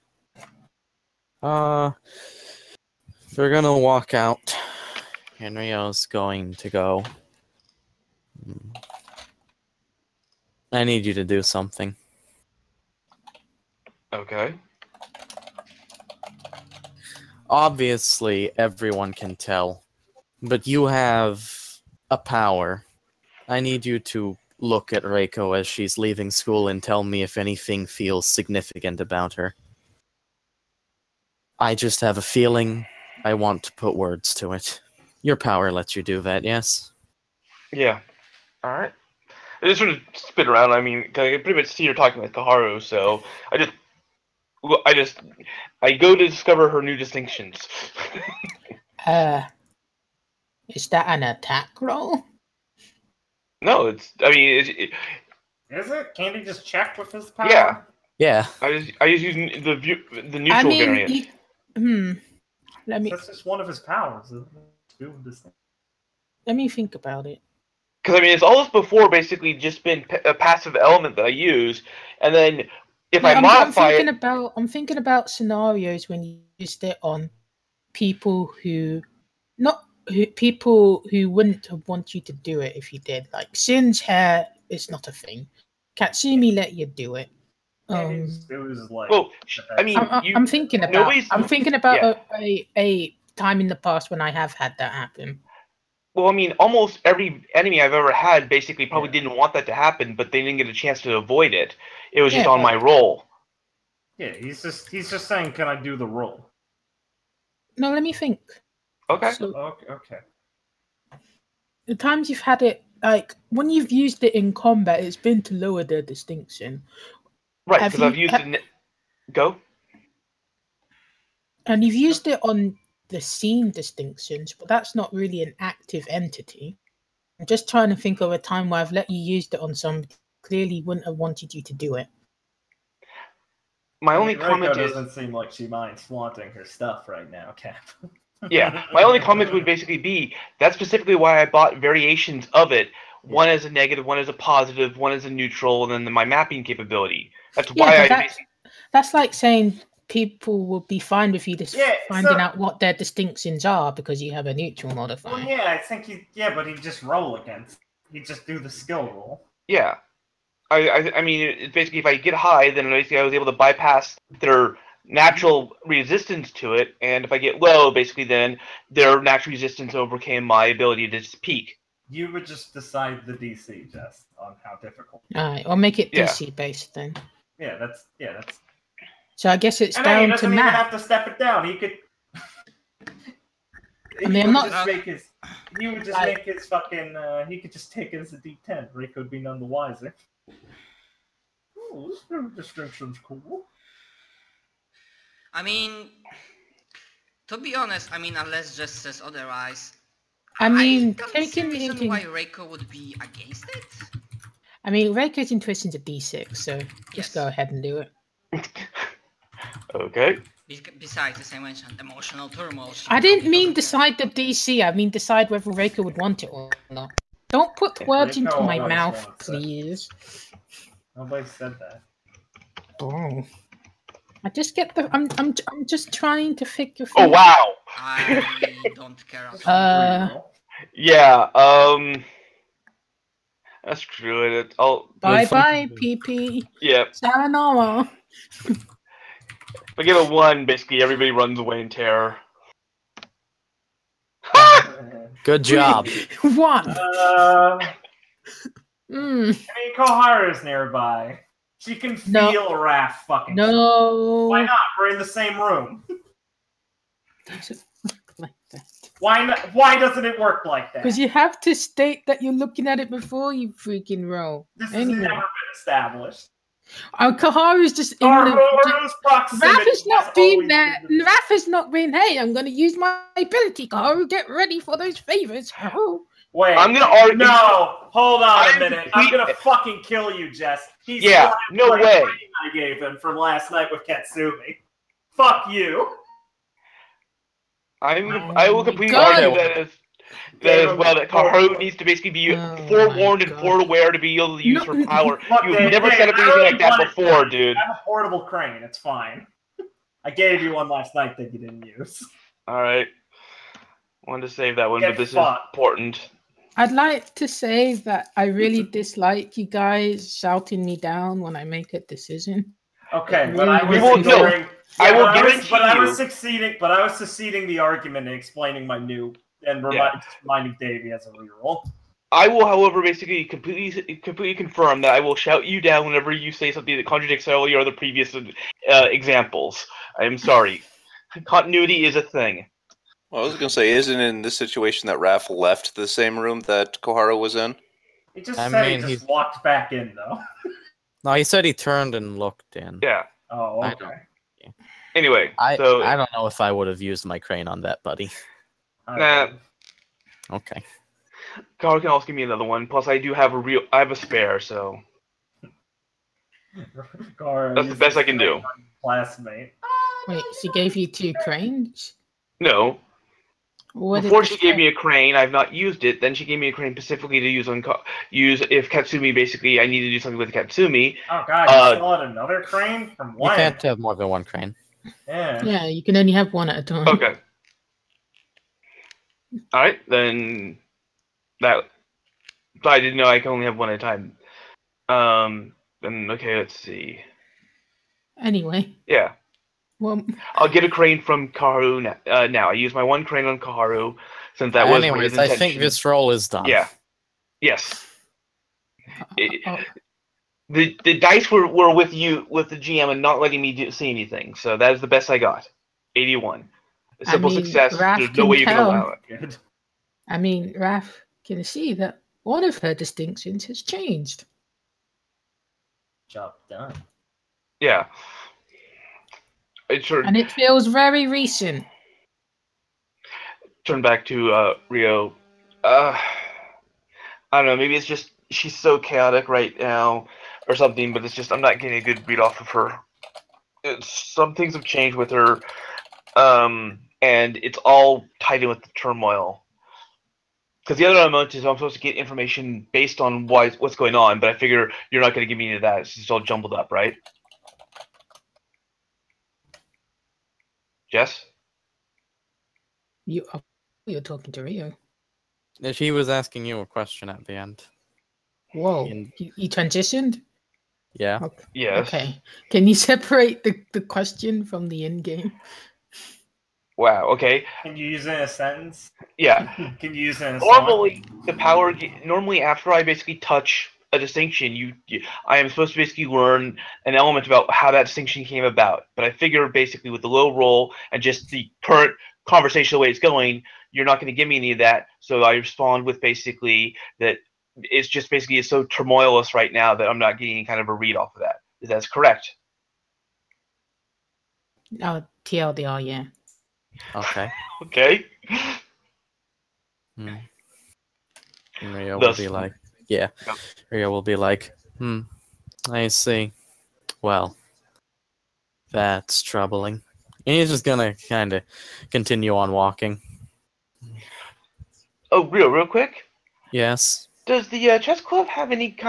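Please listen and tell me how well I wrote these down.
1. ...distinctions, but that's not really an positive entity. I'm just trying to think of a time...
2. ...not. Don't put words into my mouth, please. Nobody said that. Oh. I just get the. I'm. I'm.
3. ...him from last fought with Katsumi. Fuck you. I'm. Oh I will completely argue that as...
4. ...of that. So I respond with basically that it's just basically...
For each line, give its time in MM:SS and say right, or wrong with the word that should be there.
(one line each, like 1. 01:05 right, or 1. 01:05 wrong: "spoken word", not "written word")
1. 02:03 wrong: "active", not "positive"
2. 03:36 right
3. 04:42 wrong: "night", not "fought"
4. 08:04 right.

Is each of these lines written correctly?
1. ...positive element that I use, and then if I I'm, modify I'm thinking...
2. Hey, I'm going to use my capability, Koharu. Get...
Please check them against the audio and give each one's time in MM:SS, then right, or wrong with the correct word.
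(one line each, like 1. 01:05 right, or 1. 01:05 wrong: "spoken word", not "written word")
1. 01:10 wrong: "passive", not "positive"
2. 04:32 wrong: "ability", not "capability".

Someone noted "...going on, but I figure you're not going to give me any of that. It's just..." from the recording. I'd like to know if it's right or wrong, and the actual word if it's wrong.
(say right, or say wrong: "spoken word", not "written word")
right.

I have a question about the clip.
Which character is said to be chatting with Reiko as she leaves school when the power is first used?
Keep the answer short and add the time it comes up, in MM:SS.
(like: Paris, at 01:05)
Kaharu, at 00:42.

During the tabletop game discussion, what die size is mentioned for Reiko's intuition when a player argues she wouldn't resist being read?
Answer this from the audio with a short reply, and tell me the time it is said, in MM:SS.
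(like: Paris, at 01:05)
D6, at 03:25.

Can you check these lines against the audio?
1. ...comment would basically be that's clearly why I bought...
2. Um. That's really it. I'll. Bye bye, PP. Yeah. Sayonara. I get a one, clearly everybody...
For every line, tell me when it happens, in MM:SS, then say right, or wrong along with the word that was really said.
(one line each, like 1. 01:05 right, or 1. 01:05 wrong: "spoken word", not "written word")
1. 02:19 wrong: "specifically", not "clearly"
2. 03:51 wrong: "basically", not "clearly".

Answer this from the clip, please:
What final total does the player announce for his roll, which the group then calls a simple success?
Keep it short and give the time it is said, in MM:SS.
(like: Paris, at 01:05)
81, at 06:46.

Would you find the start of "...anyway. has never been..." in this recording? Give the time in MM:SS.
04:24.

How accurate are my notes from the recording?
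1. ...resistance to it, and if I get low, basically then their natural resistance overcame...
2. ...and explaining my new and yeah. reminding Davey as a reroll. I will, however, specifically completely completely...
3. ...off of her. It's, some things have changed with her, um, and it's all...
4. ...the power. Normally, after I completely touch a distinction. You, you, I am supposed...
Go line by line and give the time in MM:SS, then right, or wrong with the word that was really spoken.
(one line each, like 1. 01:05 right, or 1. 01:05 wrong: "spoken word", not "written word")
1. 02:45 right
2. 05:18 wrong: "basically", not "specifically"
3. 07:12 right
4. 07:51 wrong: "basically", not "completely".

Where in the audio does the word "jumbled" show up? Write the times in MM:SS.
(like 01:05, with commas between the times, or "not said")
07:26.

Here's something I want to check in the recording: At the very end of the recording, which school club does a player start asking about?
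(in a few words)
chess club.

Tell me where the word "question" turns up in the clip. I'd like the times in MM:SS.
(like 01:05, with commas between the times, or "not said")
07:36, 07:44.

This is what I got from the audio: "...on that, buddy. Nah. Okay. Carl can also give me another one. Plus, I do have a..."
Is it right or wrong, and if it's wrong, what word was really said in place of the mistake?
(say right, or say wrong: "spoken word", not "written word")
right.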